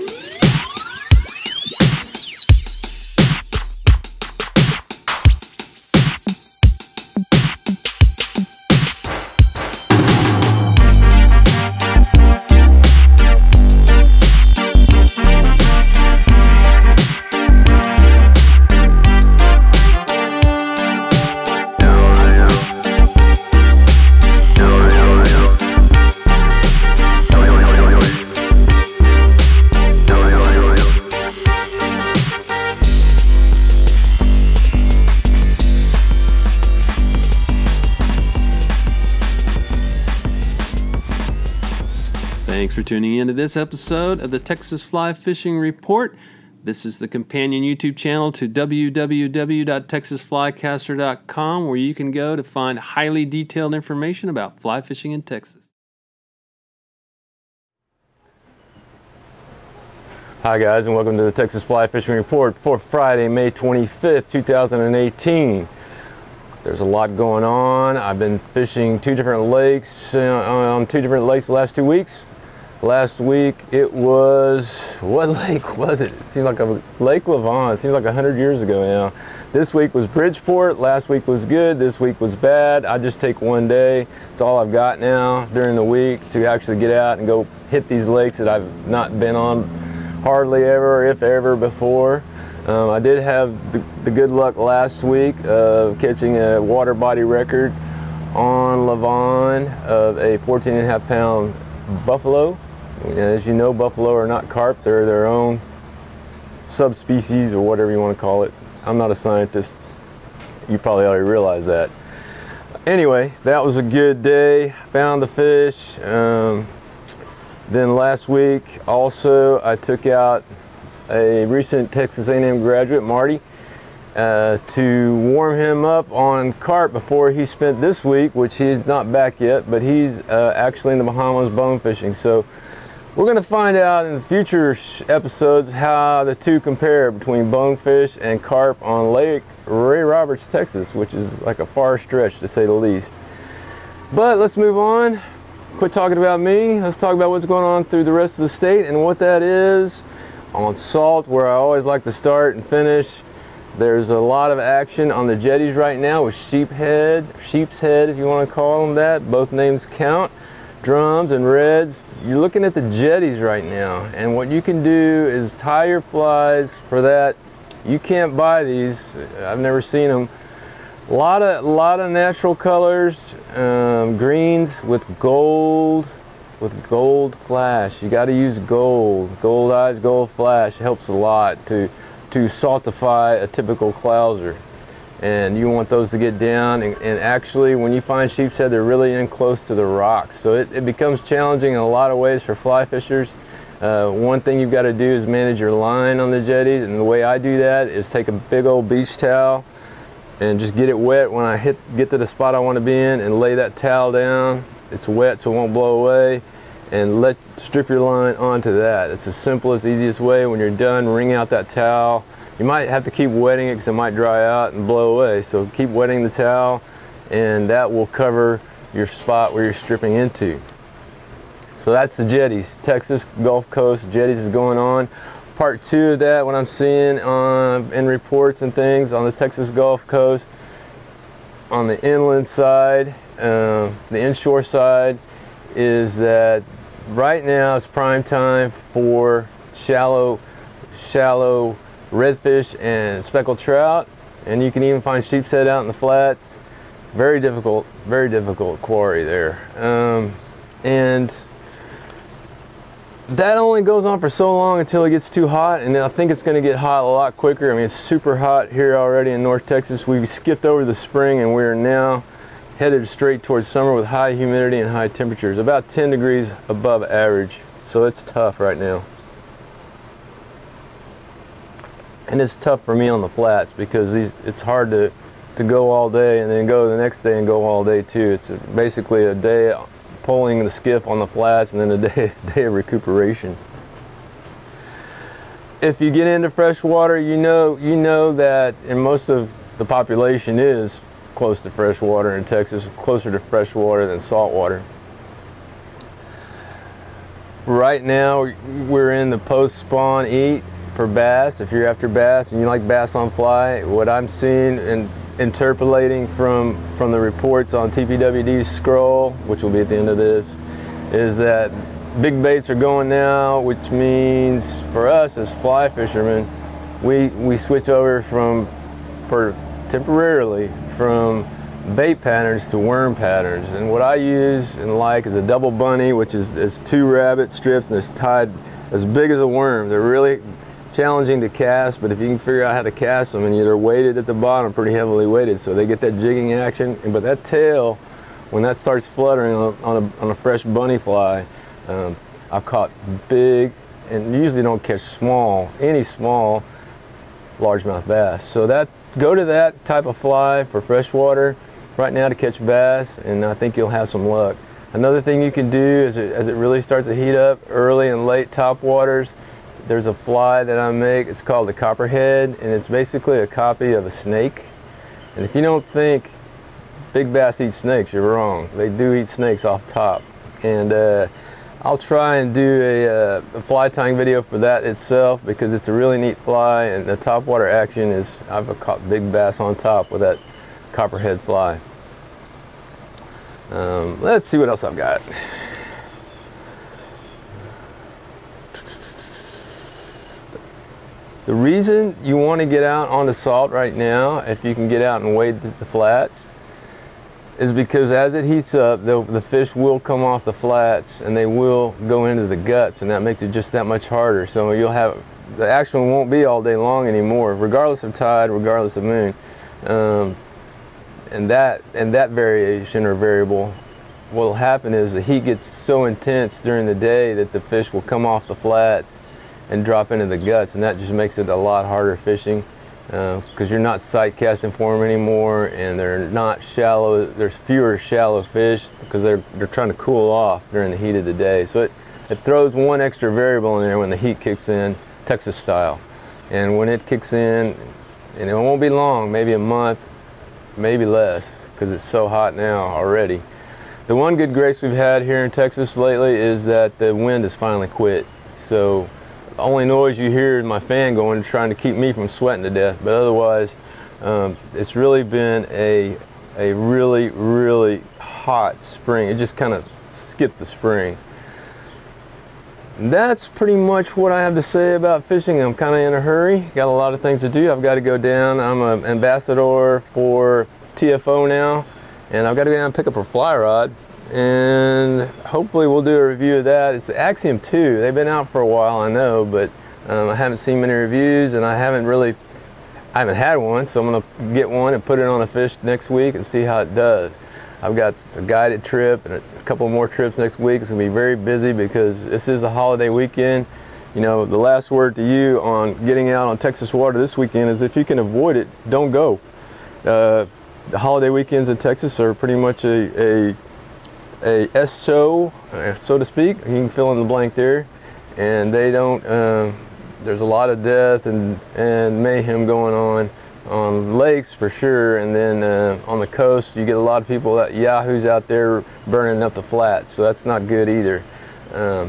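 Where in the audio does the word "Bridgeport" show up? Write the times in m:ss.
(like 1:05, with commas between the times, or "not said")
1:20.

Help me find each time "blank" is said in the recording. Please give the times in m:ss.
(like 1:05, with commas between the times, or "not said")
8:27.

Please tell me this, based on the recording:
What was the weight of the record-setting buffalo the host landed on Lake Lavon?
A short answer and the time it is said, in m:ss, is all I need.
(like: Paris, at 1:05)
14.5 pounds, at 1:40.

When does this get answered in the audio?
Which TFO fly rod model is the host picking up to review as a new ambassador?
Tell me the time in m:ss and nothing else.
7:57.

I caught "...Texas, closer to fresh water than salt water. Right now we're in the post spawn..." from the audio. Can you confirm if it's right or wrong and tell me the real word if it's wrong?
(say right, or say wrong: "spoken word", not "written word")
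right.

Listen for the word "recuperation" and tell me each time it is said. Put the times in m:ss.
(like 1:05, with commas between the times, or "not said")
4:42.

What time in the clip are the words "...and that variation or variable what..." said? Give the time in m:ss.
6:51.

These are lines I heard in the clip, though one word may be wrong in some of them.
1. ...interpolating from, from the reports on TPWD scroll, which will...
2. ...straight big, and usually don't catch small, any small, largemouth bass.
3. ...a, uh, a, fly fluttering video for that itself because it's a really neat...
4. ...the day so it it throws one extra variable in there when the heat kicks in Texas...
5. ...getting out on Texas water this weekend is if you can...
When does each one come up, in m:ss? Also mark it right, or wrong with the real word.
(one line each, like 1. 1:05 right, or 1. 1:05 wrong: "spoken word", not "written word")
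1. 5:05 right
2. 5:42 wrong: "caught", not "straight"
3. 6:12 wrong: "tying", not "fluttering"
4. 7:11 right
5. 8:16 right.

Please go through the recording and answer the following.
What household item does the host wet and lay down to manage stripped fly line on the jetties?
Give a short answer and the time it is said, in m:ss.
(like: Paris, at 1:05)
Beach towel, at 3:18.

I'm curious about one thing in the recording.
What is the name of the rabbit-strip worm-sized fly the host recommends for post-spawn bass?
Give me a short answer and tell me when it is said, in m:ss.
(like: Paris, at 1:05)
Double bunny, at 5:25.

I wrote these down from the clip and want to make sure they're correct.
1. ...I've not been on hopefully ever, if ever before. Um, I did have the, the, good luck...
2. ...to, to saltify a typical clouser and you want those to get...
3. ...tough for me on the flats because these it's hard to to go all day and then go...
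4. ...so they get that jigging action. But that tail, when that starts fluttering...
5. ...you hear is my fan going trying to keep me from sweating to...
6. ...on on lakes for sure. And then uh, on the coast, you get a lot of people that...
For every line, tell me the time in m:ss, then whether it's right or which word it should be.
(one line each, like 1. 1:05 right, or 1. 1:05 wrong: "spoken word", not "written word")
1. 1:28 wrong: "hardly", not "hopefully"
2. 3:01 right
3. 4:32 right
4. 5:35 right
5. 7:30 right
6. 8:32 right.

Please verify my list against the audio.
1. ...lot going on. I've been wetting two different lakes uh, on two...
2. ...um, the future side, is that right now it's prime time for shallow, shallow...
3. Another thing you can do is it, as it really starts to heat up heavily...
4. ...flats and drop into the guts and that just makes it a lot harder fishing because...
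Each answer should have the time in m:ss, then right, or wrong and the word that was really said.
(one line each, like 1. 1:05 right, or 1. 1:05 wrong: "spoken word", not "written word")
1. 1:06 wrong: "fishing", not "wetting"
2. 3:53 wrong: "inshore", not "future"
3. 5:54 wrong: "early", not "heavily"
4. 6:58 right.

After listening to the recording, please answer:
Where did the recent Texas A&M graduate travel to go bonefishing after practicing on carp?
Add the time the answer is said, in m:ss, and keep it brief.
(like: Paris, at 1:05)
Bahamas, at 2:11.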